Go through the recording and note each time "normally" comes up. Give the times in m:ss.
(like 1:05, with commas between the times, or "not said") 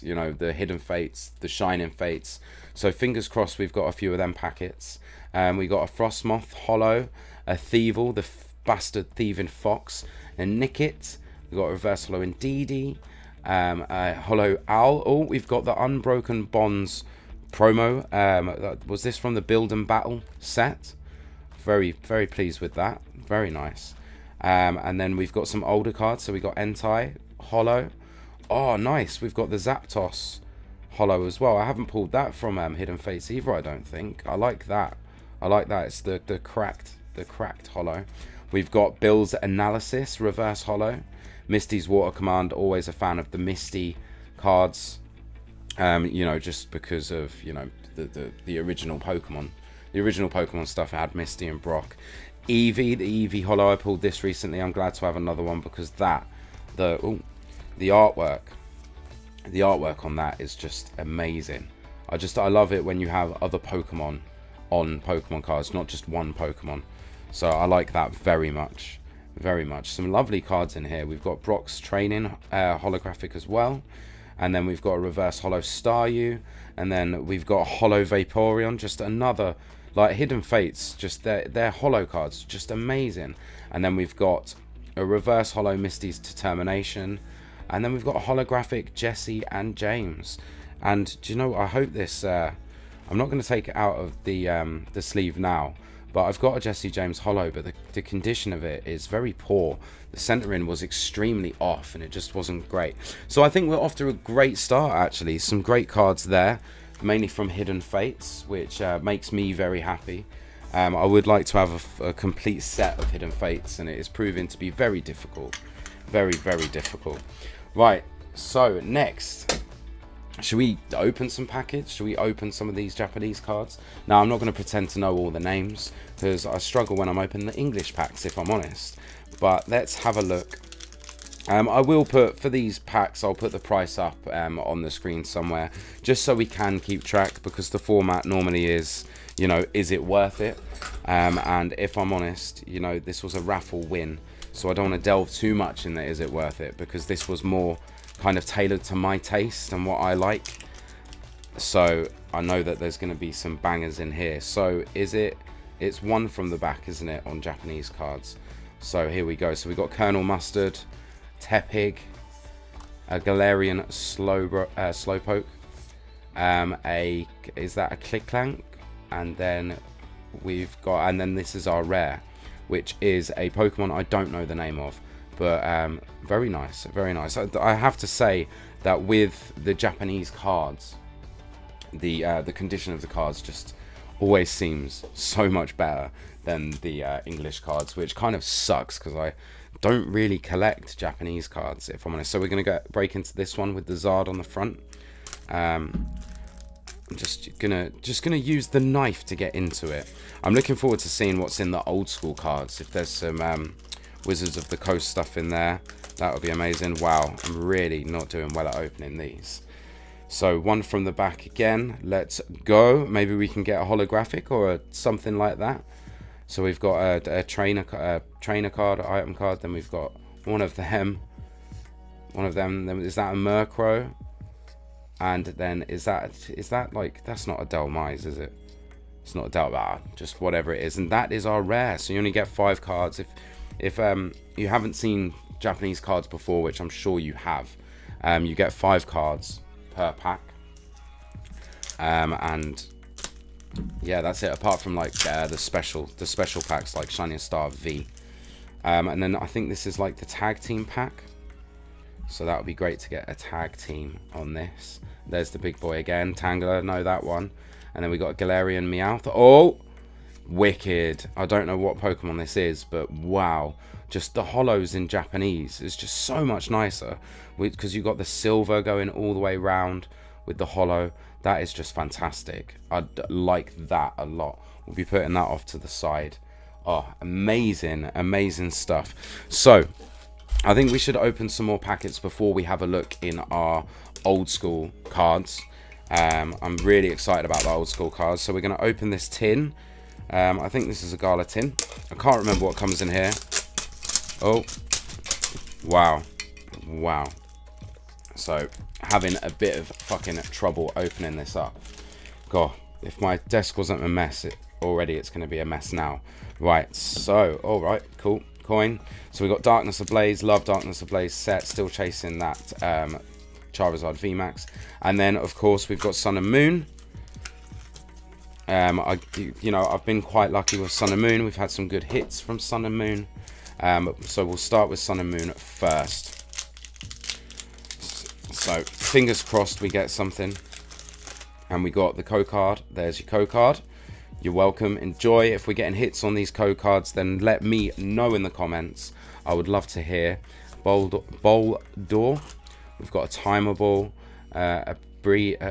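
2:18.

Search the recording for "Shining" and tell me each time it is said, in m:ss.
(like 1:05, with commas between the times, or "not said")
0:01, 4:07.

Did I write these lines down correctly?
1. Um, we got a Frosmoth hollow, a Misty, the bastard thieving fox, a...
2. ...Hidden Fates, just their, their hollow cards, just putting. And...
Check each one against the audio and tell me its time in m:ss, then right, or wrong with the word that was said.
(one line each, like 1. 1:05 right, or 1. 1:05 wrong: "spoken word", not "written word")
1. 0:05 wrong: "Thievul", not "Misty"
2. 1:20 wrong: "amazing", not "putting".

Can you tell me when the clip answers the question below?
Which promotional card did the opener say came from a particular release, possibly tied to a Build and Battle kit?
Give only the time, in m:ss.
0:15.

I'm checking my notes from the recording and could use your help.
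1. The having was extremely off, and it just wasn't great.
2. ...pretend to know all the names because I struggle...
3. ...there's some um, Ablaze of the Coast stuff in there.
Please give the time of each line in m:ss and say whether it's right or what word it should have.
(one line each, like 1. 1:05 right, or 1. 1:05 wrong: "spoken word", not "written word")
1. 1:40 wrong: "centering", not "having"
2. 2:04 right
3. 3:22 wrong: "Wizards", not "Ablaze".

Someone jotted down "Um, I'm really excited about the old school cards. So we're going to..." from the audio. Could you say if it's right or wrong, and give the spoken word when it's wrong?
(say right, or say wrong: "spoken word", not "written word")
right.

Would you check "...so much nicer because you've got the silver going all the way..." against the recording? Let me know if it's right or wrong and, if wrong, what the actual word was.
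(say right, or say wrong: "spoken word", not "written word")
right.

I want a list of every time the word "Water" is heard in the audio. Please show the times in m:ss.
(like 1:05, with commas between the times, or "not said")
0:41.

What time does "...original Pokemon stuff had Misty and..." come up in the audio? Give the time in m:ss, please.
0:49.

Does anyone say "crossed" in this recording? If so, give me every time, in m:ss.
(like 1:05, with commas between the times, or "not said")
0:03, 5:29.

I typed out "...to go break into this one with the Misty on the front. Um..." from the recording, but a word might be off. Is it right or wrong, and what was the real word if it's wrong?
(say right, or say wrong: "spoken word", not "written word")
wrong: "Zard", not "Misty".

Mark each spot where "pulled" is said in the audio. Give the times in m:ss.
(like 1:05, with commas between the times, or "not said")
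0:31, 0:53.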